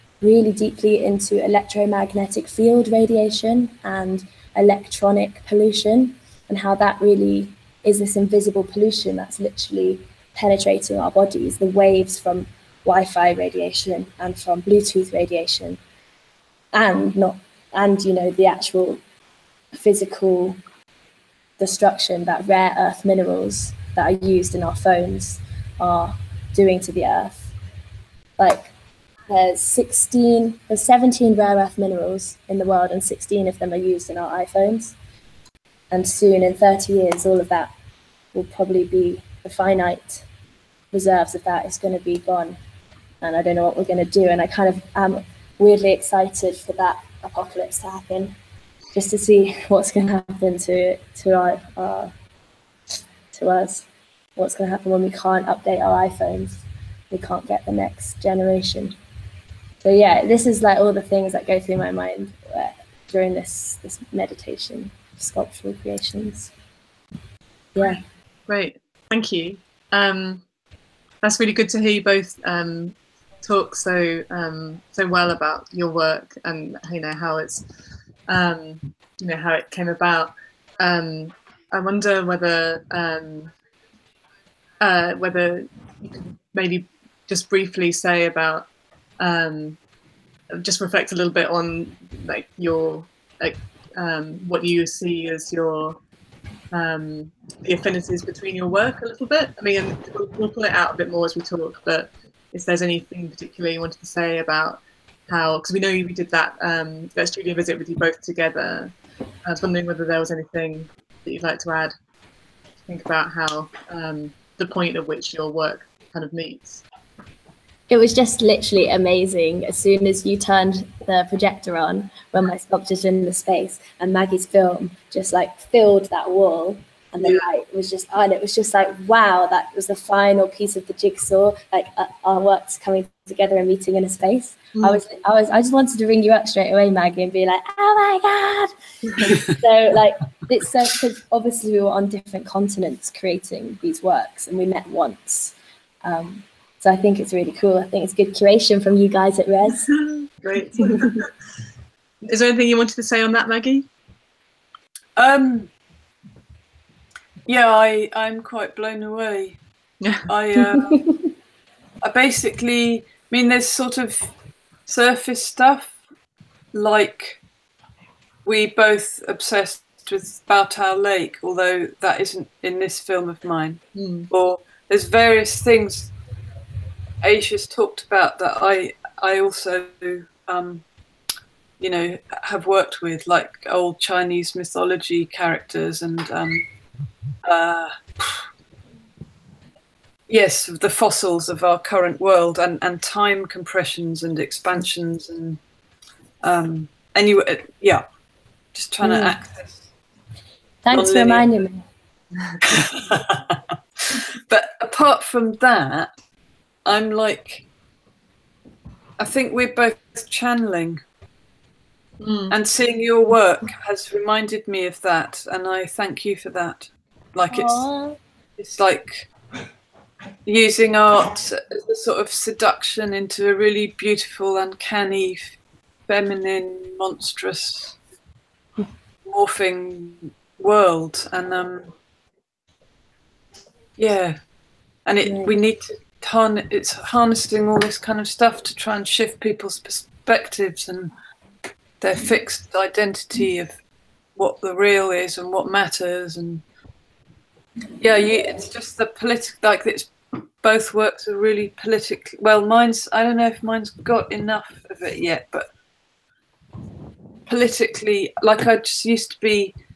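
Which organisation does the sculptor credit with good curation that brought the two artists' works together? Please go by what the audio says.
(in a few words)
Res.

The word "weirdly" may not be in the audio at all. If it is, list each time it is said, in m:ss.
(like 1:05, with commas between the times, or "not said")
0:45.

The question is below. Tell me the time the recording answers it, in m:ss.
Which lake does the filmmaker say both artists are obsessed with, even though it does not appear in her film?
2:50.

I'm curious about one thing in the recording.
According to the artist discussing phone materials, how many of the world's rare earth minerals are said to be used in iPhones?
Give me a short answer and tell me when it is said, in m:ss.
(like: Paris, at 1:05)
16, at 0:33.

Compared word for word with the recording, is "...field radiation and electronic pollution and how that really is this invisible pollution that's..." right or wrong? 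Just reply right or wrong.
right.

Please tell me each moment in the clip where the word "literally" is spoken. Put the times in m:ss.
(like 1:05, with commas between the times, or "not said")
0:09, 1:58.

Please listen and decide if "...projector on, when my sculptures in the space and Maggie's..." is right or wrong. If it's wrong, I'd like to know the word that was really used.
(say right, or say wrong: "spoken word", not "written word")
right.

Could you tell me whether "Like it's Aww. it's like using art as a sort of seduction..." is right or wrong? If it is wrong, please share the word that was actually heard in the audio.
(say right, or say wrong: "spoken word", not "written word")
right.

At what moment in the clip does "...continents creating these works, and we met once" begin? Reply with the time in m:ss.
2:22.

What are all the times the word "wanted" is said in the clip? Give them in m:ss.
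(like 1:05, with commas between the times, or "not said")
1:43, 2:15, 2:32.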